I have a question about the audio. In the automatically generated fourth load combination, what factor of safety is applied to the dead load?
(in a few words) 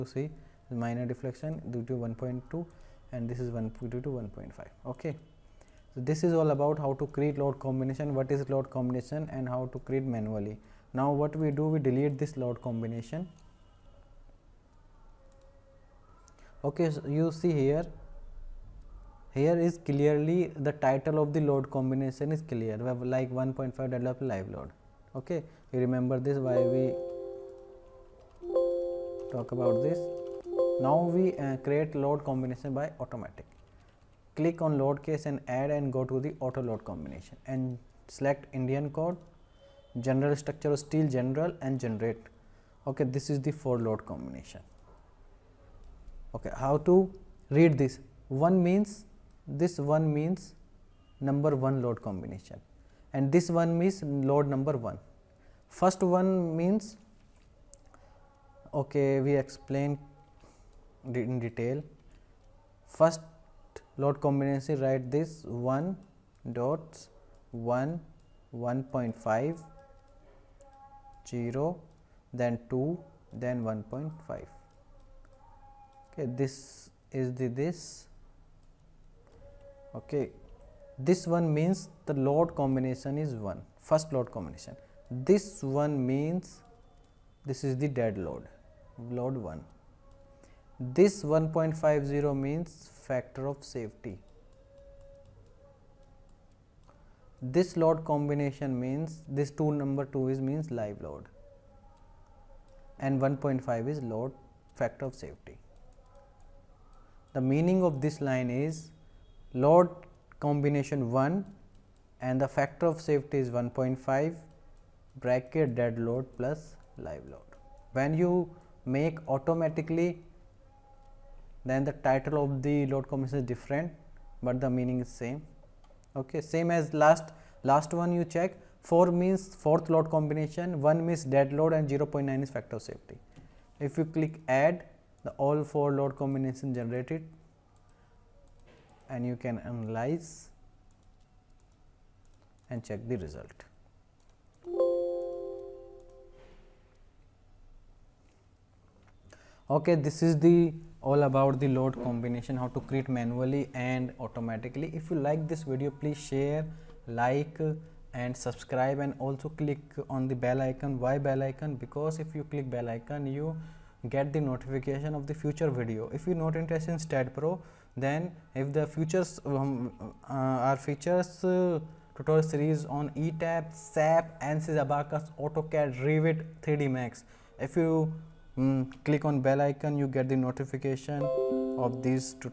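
0.9.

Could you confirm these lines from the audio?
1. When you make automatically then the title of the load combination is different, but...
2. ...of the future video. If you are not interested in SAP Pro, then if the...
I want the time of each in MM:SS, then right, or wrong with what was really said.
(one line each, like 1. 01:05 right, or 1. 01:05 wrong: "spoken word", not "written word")
1. 01:57 right
2. 02:45 wrong: "STAAD", not "SAP".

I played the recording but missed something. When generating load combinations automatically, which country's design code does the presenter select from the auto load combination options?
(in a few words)
Indian.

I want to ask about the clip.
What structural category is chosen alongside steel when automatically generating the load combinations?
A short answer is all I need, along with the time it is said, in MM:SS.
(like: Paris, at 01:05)
General structure, at 00:40.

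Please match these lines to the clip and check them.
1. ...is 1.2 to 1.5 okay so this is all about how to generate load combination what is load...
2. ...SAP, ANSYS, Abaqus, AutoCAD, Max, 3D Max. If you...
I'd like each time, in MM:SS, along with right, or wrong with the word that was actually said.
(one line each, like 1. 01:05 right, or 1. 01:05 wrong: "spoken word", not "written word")
1. 00:03 wrong: "create", not "generate"
2. 02:53 wrong: "Revit", not "Max".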